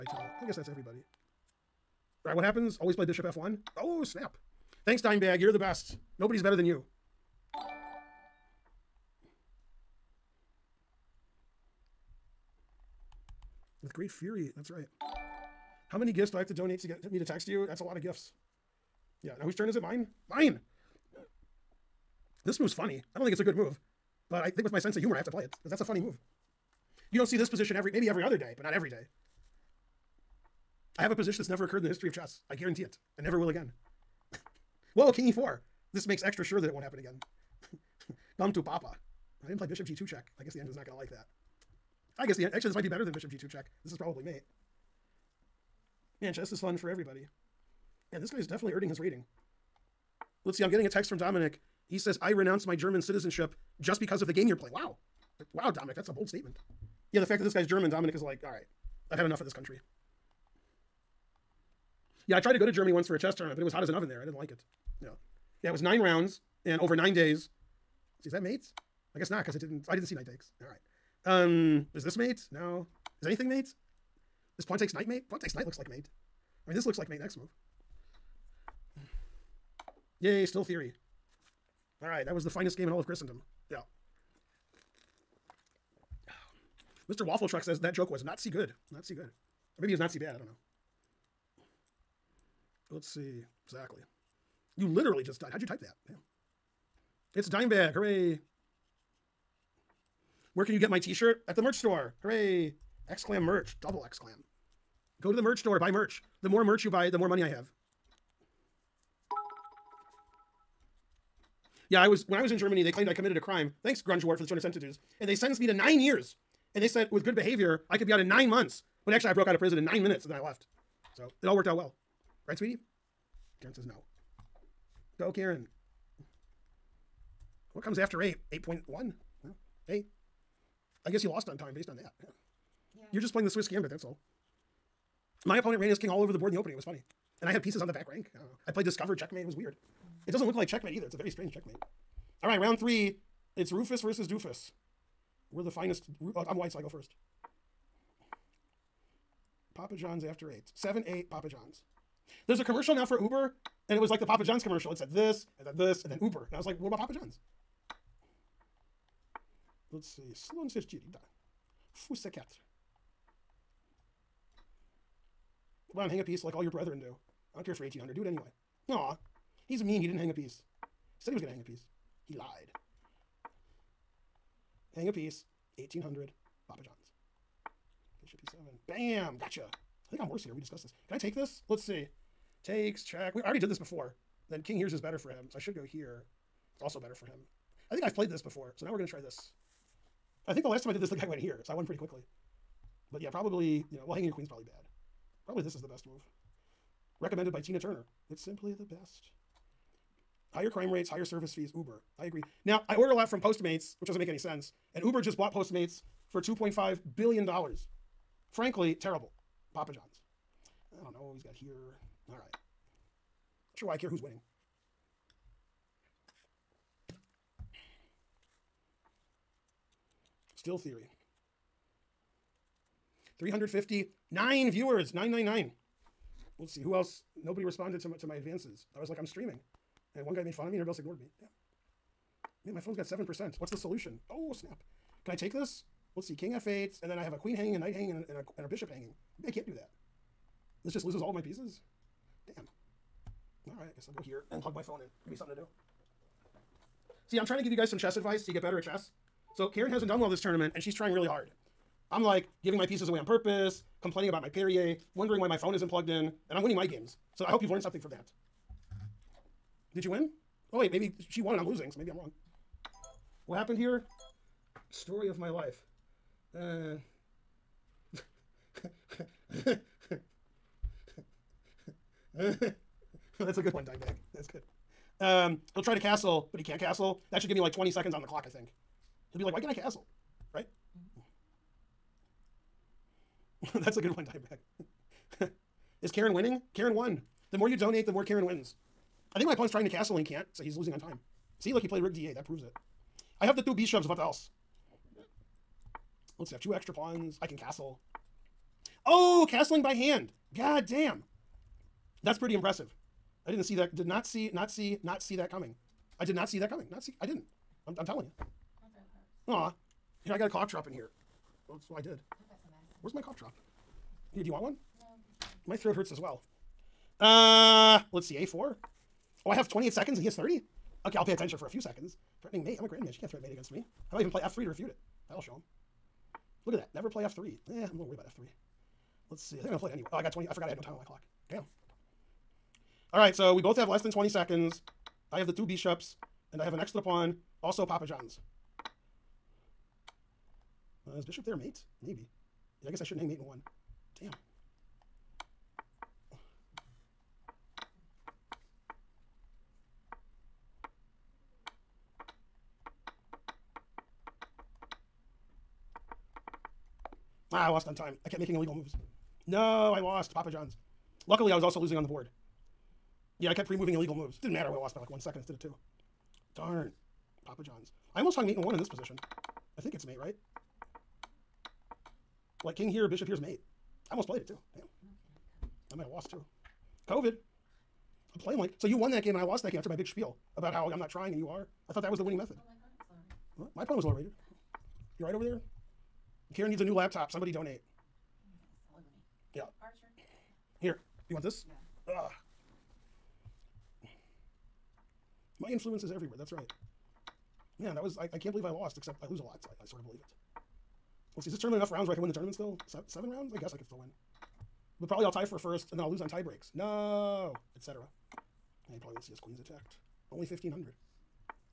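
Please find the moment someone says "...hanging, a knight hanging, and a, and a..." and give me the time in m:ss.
3:57.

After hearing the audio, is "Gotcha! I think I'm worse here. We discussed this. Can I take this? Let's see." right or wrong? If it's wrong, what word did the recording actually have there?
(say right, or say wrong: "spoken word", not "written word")
right.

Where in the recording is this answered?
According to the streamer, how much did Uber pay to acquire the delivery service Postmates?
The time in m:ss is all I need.
3:26.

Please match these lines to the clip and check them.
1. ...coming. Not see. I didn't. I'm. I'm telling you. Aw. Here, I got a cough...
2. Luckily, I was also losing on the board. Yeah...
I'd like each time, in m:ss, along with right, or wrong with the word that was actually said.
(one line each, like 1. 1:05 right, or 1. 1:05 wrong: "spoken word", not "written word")
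1. 5:06 right
2. 6:01 right.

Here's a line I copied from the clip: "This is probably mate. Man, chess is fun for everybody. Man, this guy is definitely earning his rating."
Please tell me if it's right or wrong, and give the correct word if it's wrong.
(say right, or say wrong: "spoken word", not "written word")
right.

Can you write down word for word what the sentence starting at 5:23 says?
She can't threaten mate against me.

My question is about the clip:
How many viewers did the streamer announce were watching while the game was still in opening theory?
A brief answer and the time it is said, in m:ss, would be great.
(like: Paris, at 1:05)
359, at 3:43.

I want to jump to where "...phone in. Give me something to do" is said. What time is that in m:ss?
4:04.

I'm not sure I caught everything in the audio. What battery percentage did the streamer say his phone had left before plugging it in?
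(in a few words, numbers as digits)
7%.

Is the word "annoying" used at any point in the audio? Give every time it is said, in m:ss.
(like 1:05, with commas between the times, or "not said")
not said.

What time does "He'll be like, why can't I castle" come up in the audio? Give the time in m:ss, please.
4:39.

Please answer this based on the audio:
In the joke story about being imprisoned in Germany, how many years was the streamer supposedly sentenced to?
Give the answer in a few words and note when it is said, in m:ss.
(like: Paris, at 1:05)
9 years, at 1:55.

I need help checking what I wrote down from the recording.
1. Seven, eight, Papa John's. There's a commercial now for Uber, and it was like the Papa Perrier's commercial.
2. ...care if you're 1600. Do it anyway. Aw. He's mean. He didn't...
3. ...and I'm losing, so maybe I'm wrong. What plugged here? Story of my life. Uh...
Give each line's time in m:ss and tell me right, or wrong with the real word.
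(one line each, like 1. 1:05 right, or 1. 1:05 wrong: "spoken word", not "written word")
1. 2:30 wrong: "John", not "Perrier"
2. 2:47 wrong: "1800", not "1600"
3. 4:21 wrong: "happened", not "plugged".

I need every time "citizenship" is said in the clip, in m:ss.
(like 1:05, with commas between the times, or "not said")
0:53.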